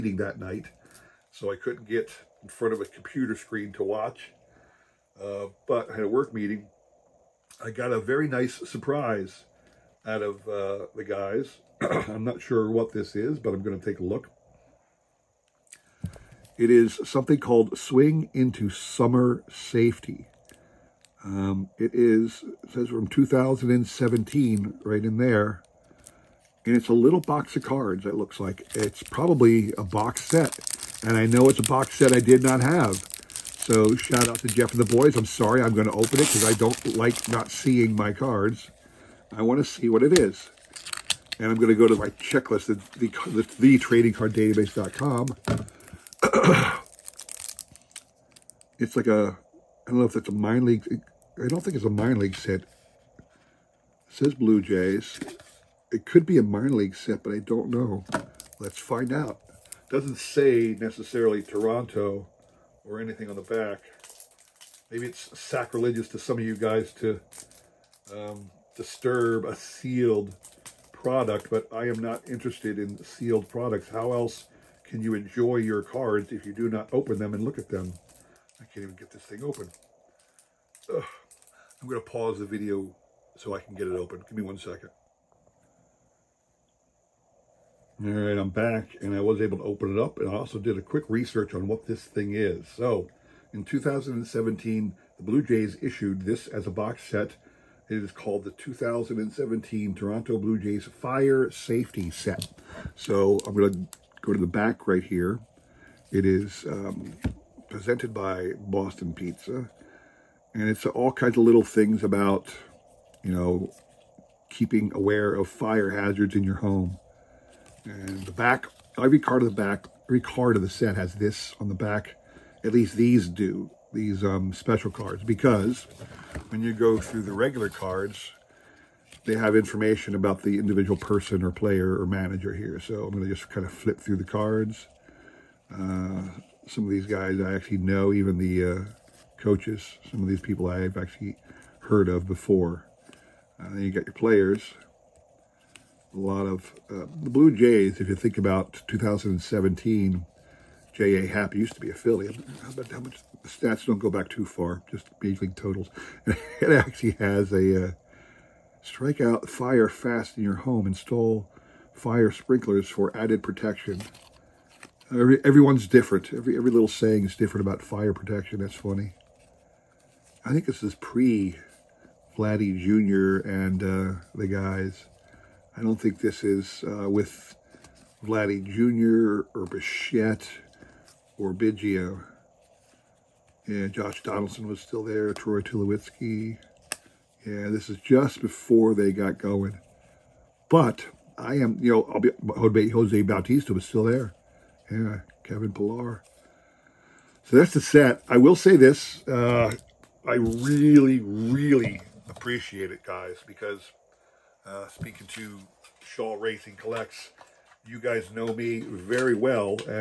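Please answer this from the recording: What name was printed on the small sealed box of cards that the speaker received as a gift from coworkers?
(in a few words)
Swing into Summer Safety.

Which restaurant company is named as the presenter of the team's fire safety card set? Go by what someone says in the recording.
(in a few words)
Boston Pizza.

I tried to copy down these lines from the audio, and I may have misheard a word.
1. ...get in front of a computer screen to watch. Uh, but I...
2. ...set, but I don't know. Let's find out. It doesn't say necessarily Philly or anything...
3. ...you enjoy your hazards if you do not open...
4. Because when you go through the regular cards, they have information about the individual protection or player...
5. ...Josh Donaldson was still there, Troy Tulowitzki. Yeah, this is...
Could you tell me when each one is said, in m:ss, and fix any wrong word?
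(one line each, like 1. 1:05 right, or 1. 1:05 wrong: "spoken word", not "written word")
1. 0:01 right
2. 0:56 wrong: "Toronto", not "Philly"
3. 1:15 wrong: "cards", not "hazards"
4. 2:05 wrong: "person", not "protection"
5. 3:03 right.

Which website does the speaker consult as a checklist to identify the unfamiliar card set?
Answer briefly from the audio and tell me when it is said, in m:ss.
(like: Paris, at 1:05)
tradingcarddatabase.com, at 0:43.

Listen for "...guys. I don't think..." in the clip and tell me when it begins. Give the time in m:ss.
2:54.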